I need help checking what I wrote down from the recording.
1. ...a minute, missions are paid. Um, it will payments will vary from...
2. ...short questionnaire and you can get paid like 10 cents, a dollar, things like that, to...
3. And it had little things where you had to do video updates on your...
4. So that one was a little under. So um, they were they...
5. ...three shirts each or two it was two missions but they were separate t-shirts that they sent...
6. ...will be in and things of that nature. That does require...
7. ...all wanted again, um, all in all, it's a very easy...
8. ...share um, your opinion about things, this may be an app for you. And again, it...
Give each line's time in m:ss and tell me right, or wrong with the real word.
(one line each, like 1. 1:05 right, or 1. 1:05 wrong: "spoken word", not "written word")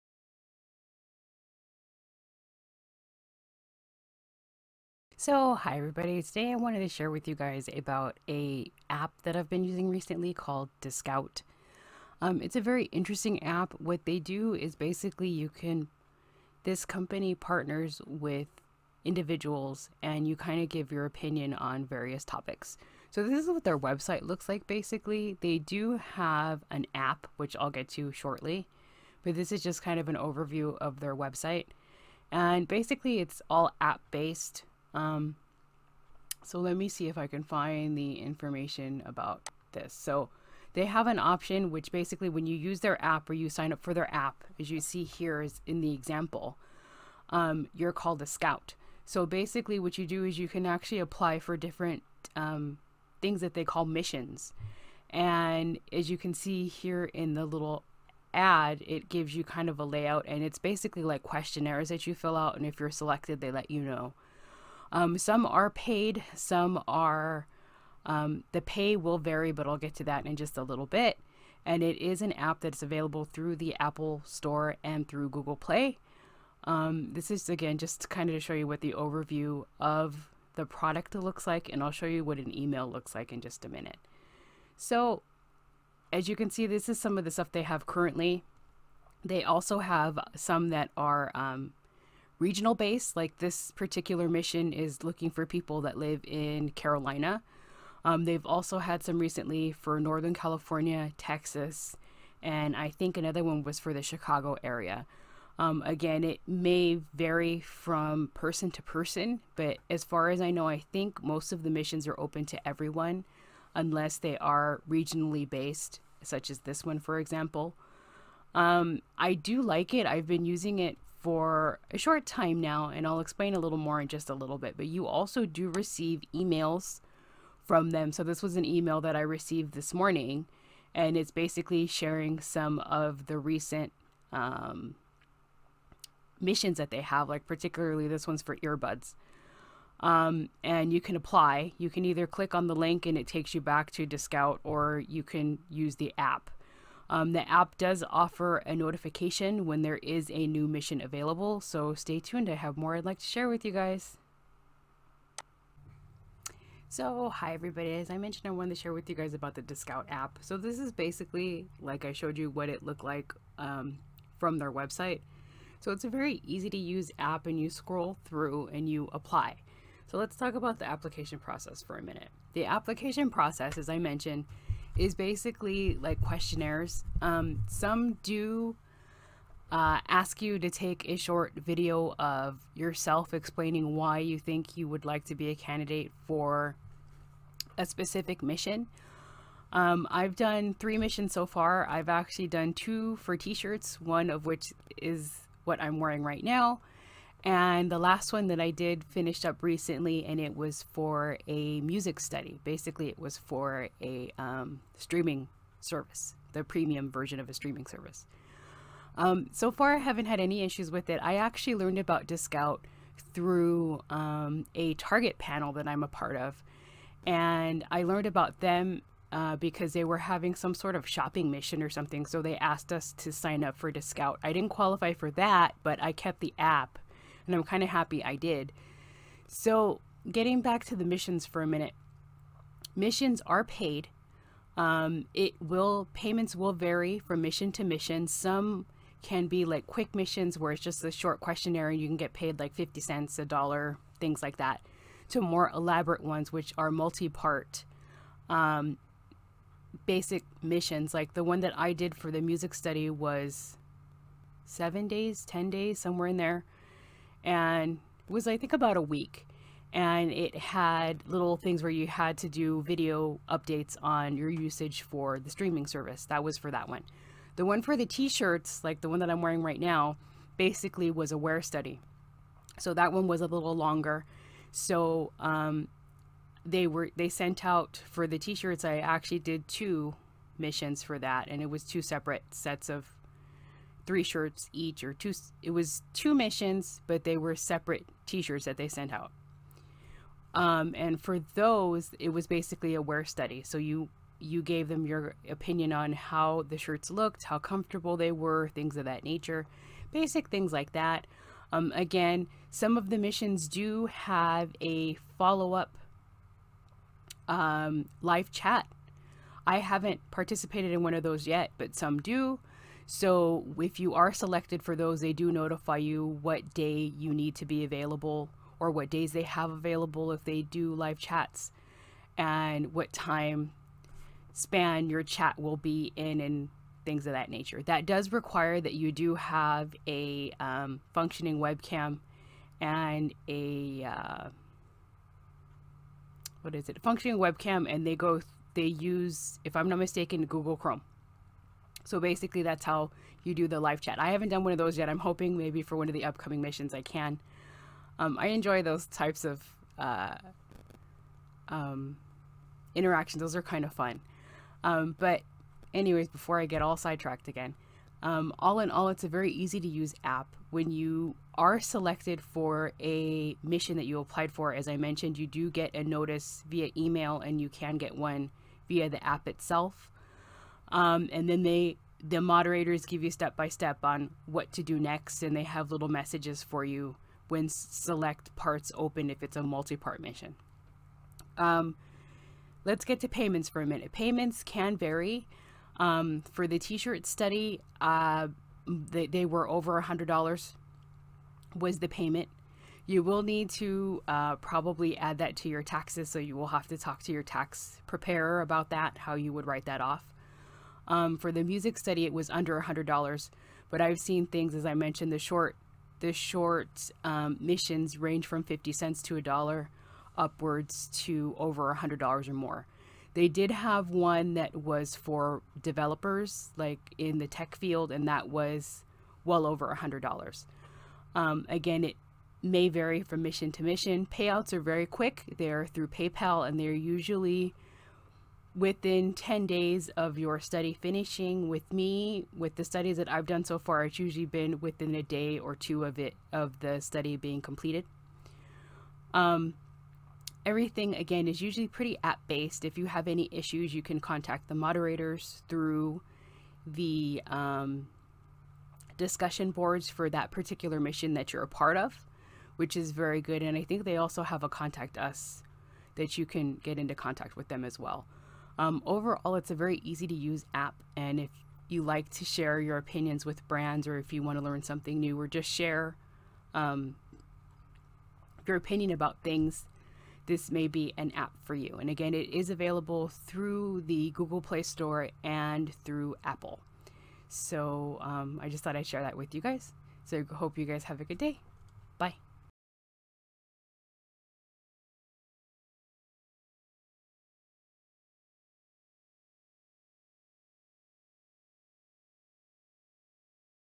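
1. 3:51 right
2. 4:01 wrong: "50", not "10"
3. 4:19 right
4. 4:32 wrong: "longer", not "under"
5. 4:44 right
6. 5:25 right
7. 5:56 wrong: "sidetracked", not "wanted"
8. 7:45 right.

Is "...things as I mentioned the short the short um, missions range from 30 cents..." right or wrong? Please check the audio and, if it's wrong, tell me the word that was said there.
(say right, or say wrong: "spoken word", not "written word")
wrong: "50", not "30".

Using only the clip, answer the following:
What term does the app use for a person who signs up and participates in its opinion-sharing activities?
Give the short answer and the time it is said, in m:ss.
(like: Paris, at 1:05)
scout, at 0:48.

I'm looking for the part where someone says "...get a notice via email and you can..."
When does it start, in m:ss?
6:05.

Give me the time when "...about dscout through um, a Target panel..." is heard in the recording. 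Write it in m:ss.
3:31.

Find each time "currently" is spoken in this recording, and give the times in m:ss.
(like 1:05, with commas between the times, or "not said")
1:27.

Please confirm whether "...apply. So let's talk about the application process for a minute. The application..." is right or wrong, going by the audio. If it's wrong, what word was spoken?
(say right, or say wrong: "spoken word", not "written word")
right.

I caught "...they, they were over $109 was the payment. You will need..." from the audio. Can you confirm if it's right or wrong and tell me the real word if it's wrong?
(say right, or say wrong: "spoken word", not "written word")
wrong: "100", not "109".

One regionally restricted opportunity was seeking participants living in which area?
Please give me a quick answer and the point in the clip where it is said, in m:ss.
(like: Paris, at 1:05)
Carolina, at 1:36.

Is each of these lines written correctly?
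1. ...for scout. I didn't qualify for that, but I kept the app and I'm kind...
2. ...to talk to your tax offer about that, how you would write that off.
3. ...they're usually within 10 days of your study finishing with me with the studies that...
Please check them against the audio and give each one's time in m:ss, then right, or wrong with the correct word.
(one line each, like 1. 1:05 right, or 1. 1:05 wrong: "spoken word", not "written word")
1. 3:43 wrong: "dscout", not "scout"
2. 6:36 wrong: "preparer", not "offer"
3. 7:06 right.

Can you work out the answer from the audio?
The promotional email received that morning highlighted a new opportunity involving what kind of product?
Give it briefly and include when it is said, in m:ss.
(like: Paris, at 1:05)
earbuds, at 2:18.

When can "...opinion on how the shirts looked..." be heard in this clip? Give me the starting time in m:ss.
4:55.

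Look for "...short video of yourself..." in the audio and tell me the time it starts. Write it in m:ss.
3:01.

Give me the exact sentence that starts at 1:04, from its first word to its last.
Um, some are paid, some are, um, the pay will vary, but I'll get to that in just a little bit.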